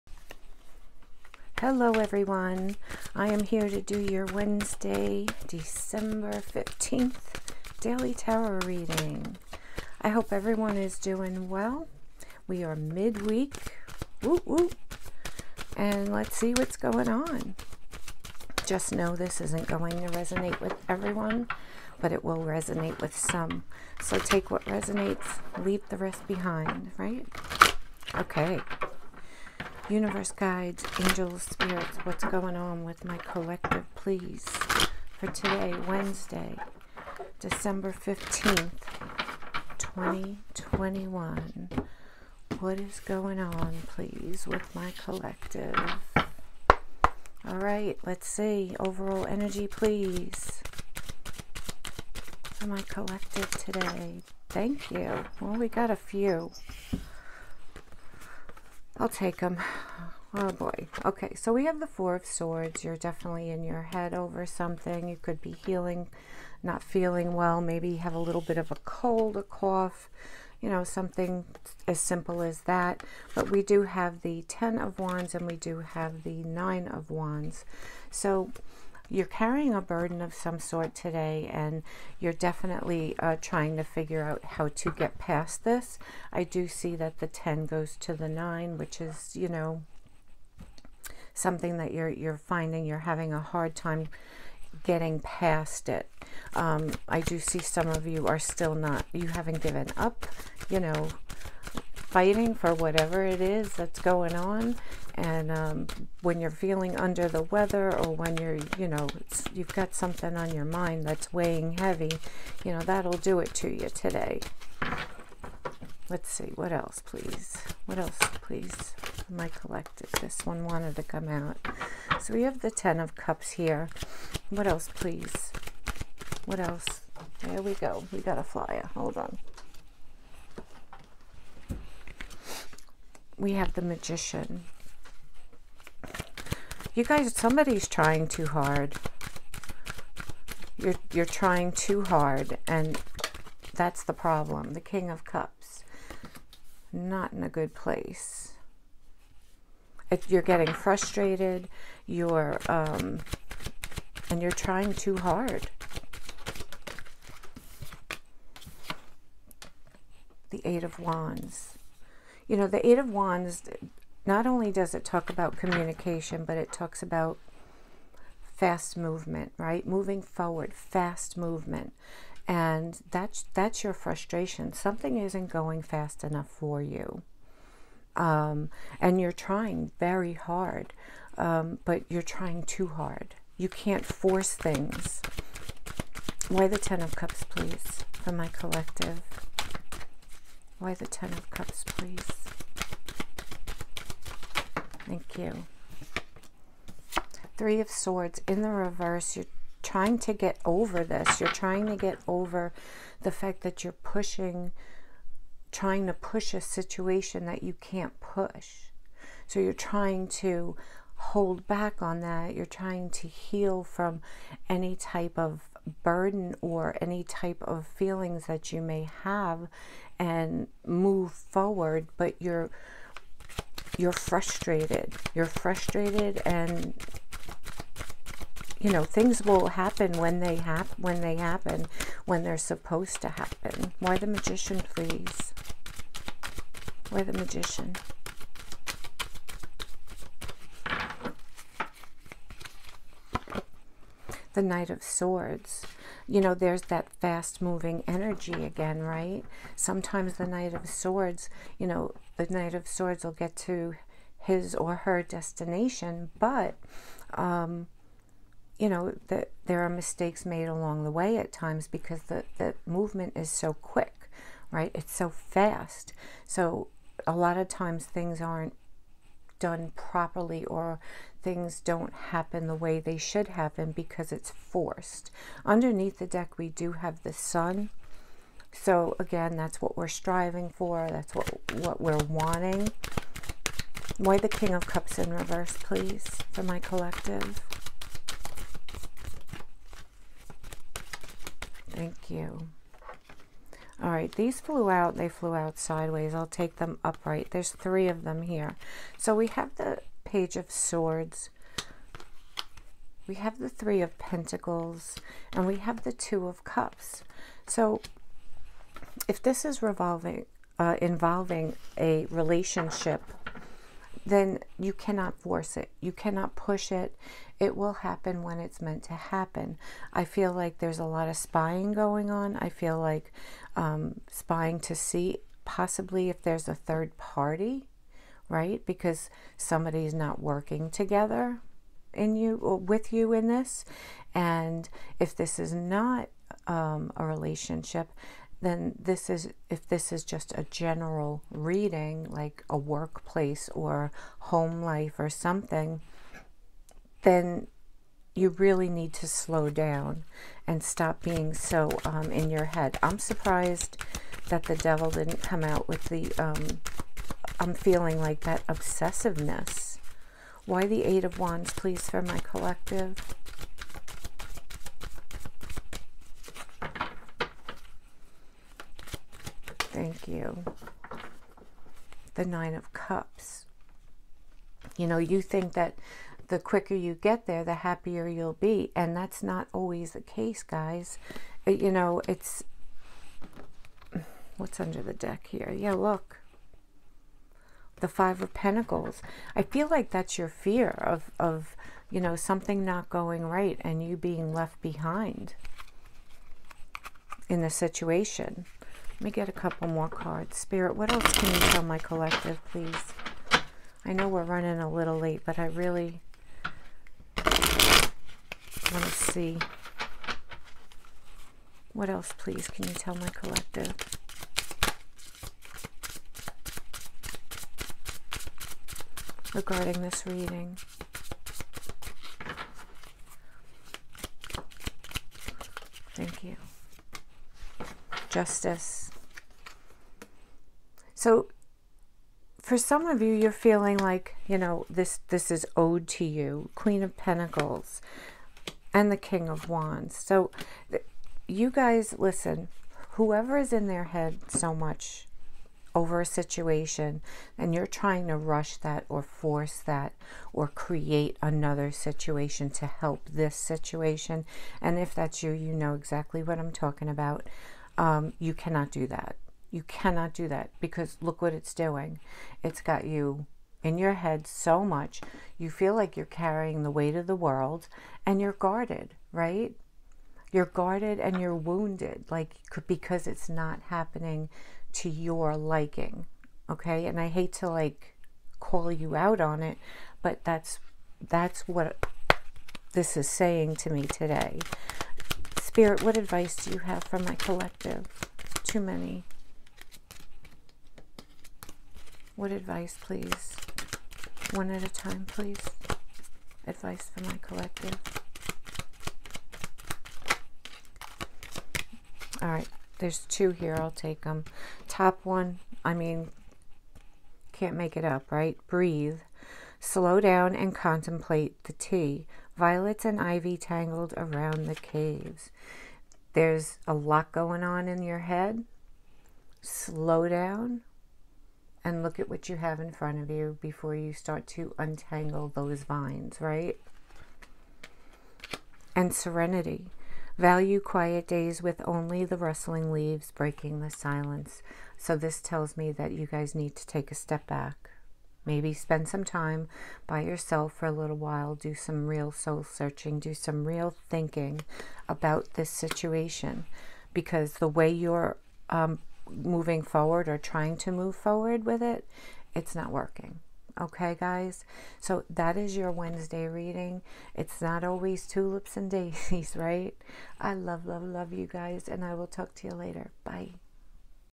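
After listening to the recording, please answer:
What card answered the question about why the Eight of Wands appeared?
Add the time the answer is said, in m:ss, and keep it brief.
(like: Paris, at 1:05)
Nine of Cups, at 6:12.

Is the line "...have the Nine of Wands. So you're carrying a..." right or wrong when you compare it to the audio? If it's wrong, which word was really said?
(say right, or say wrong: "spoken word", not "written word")
right.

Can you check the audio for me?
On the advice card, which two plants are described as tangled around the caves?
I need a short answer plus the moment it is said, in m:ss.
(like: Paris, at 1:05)
Violets and ivy, at 8:32.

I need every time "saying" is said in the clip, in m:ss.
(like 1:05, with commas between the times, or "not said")
8:03.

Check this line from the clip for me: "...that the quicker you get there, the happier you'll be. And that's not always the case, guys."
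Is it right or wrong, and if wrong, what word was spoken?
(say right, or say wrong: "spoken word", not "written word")
right.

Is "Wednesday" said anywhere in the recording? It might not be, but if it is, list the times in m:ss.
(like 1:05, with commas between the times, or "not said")
0:04, 0:35, 9:15.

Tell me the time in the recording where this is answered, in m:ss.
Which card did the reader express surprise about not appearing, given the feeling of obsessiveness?
5:54.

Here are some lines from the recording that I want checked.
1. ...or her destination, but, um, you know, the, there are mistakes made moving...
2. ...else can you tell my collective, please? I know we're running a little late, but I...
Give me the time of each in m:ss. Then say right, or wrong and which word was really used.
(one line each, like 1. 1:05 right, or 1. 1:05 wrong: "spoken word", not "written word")
1. 4:14 wrong: "along", not "moving"
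2. 6:41 right.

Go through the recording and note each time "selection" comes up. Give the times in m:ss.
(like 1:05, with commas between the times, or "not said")
not said.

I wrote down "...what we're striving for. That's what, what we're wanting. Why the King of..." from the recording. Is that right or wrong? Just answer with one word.
right.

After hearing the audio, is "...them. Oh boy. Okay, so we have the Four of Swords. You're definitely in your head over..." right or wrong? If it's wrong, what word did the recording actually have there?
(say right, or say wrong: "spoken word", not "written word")
right.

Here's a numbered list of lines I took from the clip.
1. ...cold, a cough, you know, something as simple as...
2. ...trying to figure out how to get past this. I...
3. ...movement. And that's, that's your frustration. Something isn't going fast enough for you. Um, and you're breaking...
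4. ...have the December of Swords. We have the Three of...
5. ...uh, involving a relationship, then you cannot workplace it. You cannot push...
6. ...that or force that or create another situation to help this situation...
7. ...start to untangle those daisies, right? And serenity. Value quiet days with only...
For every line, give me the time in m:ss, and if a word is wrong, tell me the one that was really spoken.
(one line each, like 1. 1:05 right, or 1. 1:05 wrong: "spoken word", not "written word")
1. 1:08 right
2. 1:23 right
3. 2:51 wrong: "trying", not "breaking"
4. 4:59 wrong: "Page", not "December"
5. 5:10 wrong: "force", not "workplace"
6. 7:28 right
7. 8:44 wrong: "vines", not "daisies".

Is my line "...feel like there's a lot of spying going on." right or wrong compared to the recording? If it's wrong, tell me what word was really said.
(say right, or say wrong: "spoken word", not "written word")
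right.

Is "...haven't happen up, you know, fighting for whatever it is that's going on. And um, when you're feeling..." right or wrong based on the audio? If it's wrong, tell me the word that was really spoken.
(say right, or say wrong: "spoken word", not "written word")
wrong: "given", not "happen".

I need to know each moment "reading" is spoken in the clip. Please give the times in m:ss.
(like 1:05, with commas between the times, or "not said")
0:08, 5:41, 7:00, 9:16.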